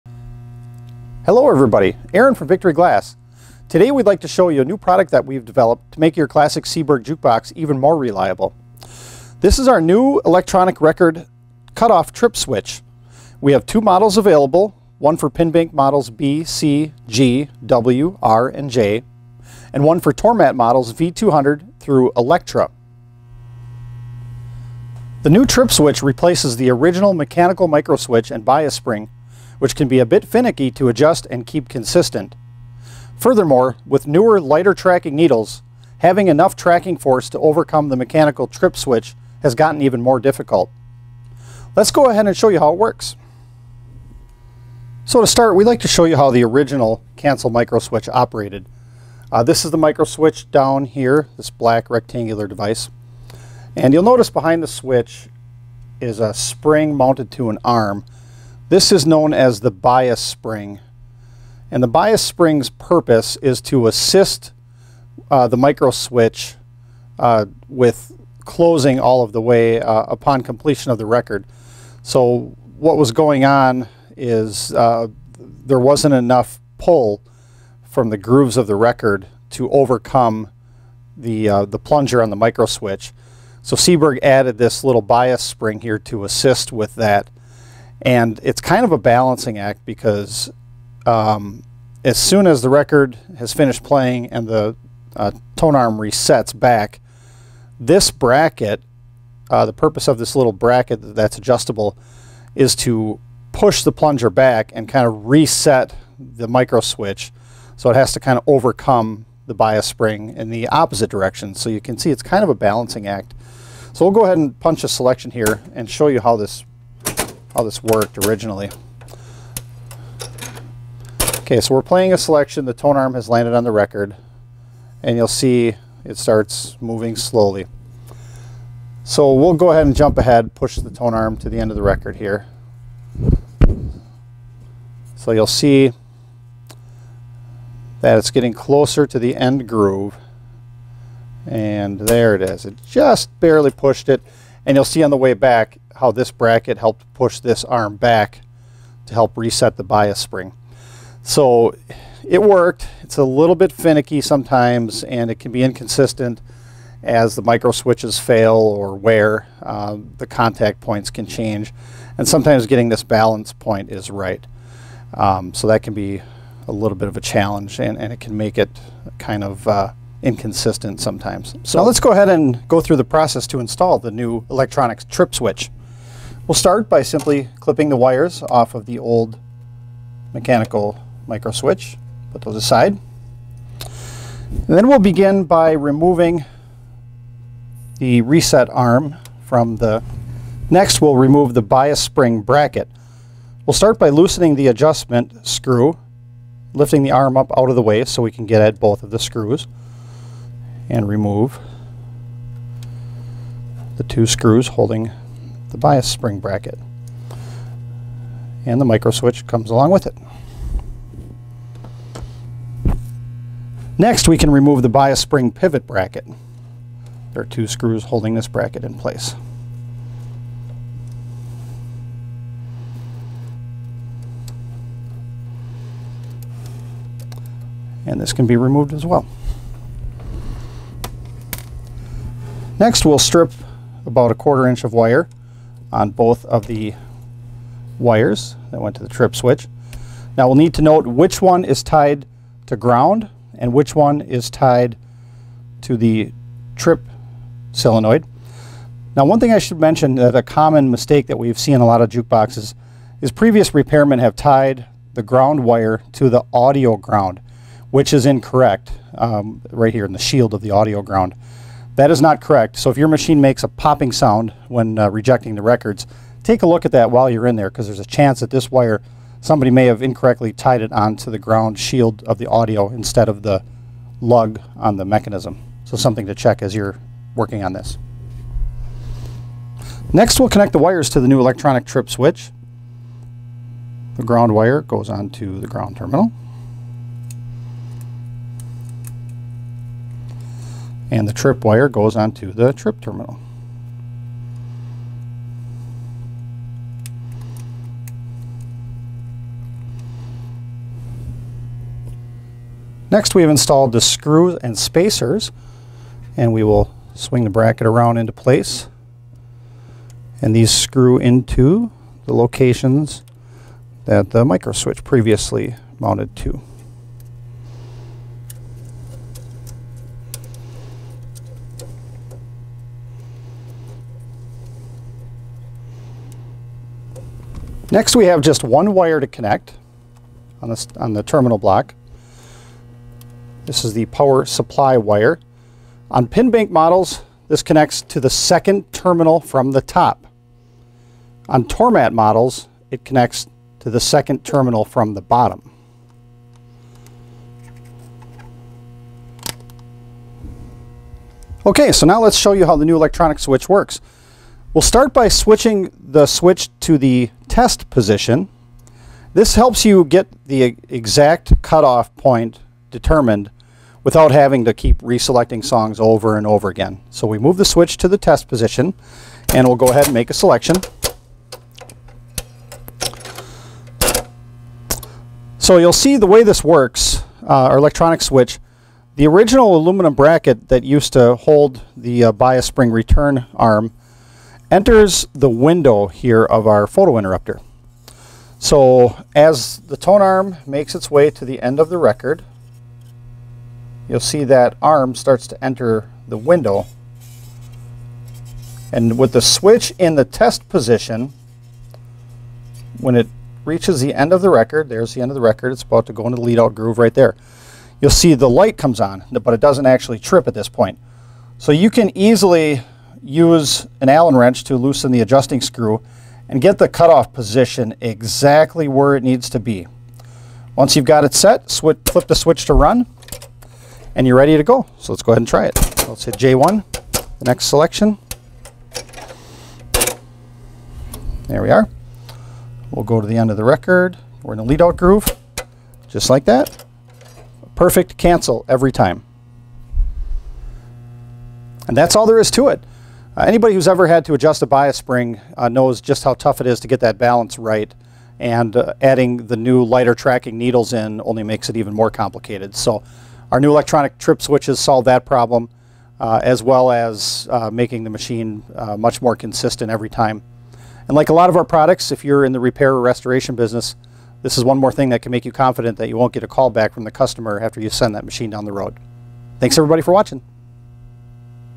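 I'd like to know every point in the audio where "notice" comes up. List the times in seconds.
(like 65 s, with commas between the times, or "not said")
54 s.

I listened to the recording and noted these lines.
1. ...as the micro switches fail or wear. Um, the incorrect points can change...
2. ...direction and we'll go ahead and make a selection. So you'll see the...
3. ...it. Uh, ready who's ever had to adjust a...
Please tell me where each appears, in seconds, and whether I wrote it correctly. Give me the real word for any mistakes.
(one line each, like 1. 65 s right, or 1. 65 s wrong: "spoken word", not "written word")
1. 157 s wrong: "contact", not "incorrect"
2. 368 s wrong: "position", not "direction"
3. 442 s wrong: "anybody", not "ready".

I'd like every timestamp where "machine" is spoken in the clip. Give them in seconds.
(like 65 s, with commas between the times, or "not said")
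263 s, 458 s, 468 s.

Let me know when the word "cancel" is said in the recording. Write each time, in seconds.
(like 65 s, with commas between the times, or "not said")
47 s, 438 s.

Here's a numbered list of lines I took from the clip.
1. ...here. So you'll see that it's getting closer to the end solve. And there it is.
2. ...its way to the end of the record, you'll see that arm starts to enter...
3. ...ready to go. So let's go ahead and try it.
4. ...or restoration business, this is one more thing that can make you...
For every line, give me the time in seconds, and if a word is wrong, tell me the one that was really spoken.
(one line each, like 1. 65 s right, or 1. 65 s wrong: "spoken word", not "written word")
1. 132 s wrong: "groove", not "solve"
2. 390 s right
3. 424 s right
4. 462 s right.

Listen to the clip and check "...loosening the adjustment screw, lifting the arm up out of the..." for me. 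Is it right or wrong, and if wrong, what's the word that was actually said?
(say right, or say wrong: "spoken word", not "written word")
right.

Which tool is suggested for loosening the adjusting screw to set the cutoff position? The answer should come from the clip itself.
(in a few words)
Allen wrench.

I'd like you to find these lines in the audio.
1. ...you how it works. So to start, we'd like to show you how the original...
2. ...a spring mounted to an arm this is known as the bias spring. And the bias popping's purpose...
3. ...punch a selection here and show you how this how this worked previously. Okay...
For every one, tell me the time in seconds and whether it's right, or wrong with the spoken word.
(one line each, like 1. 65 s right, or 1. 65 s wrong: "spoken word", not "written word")
1. 42 s right
2. 56 s wrong: "spring", not "popping"
3. 114 s wrong: "originally", not "previously".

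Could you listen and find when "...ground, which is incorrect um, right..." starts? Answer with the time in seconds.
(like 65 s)
256 s.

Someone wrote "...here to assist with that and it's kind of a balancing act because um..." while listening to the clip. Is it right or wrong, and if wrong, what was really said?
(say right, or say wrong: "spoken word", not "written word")
right.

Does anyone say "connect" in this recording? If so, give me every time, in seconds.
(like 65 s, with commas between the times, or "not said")
280 s, 329 s, 337 s, 343 s.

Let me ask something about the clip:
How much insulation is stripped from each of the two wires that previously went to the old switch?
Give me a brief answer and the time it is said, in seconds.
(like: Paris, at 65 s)
a quarter inch, at 234 s.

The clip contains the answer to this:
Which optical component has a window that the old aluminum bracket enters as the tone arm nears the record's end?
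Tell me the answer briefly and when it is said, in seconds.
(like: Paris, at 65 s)
photo interrupter, at 386 s.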